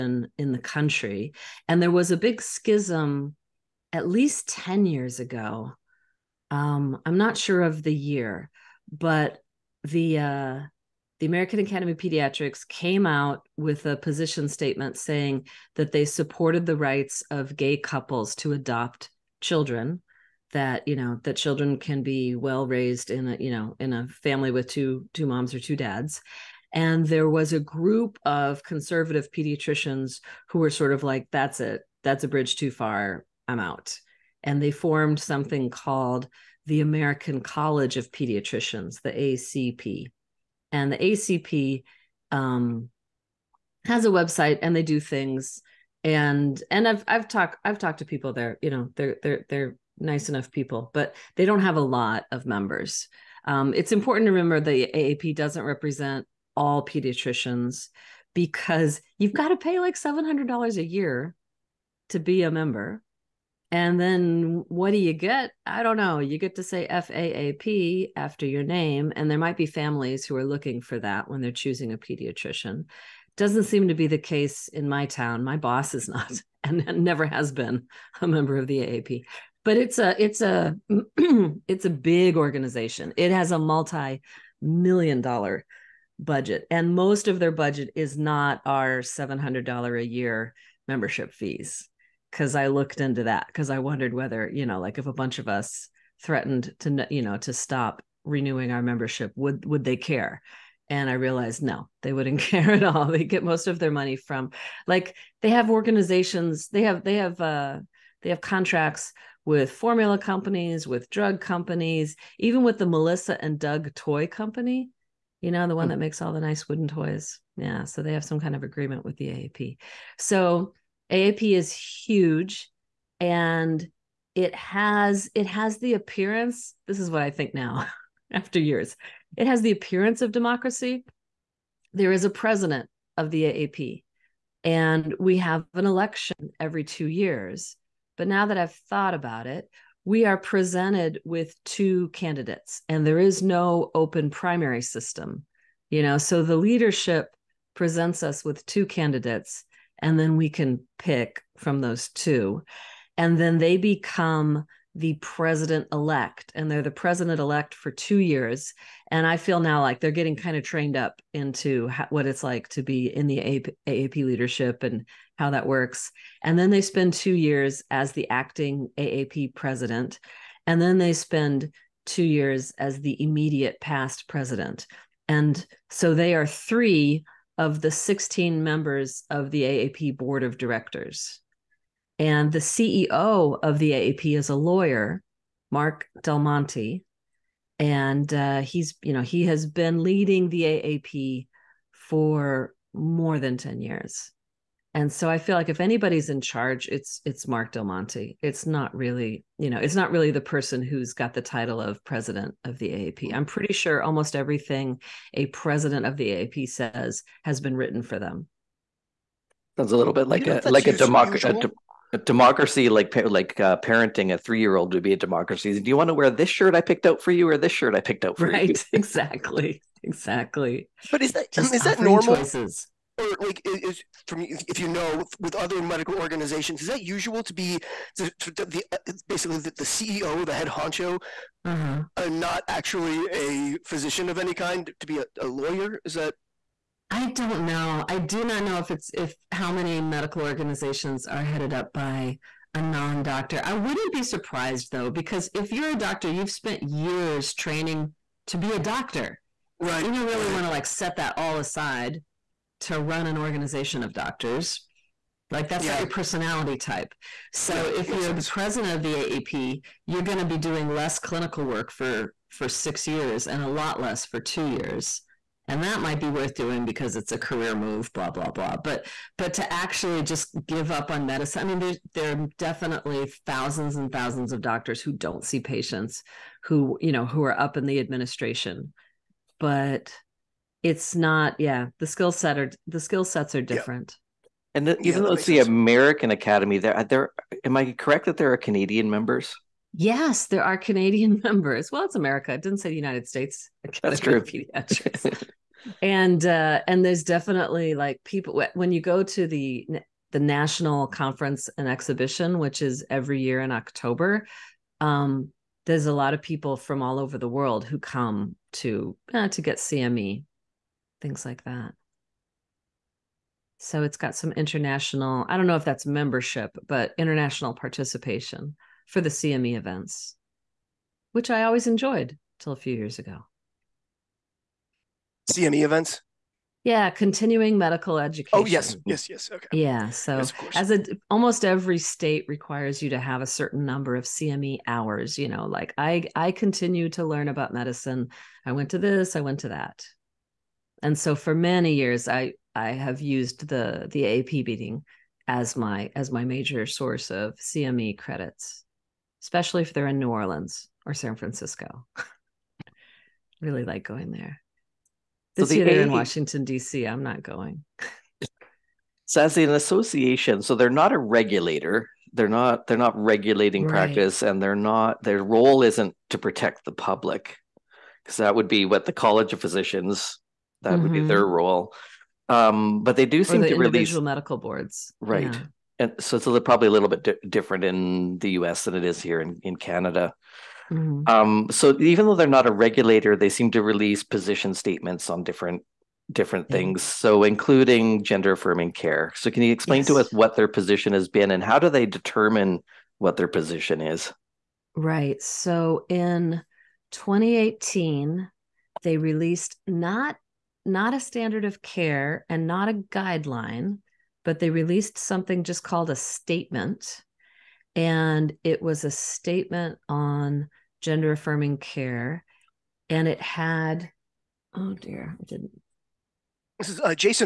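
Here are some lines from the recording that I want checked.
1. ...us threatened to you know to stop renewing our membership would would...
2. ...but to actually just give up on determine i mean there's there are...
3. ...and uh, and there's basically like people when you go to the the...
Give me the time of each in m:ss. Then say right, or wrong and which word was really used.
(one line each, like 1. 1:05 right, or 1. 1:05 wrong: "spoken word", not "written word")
1. 1:35 right
2. 4:29 wrong: "medicine", not "determine"
3. 4:56 wrong: "definitely", not "basically".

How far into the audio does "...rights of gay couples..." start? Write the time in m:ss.
0:16.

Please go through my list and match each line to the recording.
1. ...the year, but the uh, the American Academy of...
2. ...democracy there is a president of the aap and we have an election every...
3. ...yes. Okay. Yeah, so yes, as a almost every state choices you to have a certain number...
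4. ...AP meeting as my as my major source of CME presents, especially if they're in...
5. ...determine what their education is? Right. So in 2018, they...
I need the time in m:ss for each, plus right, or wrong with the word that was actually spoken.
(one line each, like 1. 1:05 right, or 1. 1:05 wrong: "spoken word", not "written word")
1. 0:07 right
2. 2:10 right
3. 5:29 wrong: "requires", not "choices"
4. 5:44 wrong: "credits", not "presents"
5. 6:32 wrong: "position", not "education".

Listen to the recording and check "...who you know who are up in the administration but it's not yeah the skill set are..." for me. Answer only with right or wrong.
right.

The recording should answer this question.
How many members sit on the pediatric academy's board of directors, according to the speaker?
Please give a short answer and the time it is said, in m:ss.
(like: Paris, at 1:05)
16, at 2:57.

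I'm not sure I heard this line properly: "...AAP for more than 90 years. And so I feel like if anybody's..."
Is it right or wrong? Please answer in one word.
wrong.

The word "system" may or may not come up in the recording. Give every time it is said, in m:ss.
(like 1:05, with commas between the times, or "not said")
2:24.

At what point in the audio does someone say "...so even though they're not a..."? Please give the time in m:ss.
6:21.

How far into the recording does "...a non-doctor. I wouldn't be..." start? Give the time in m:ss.
4:02.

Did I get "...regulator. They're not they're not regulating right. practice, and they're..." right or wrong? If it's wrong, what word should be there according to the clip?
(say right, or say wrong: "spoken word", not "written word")
right.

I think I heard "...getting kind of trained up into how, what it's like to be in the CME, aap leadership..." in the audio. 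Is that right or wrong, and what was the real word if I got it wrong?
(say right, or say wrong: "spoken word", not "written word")
wrong: "AAP", not "CME".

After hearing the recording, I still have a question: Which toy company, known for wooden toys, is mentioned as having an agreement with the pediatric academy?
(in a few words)
Melissa and Doug.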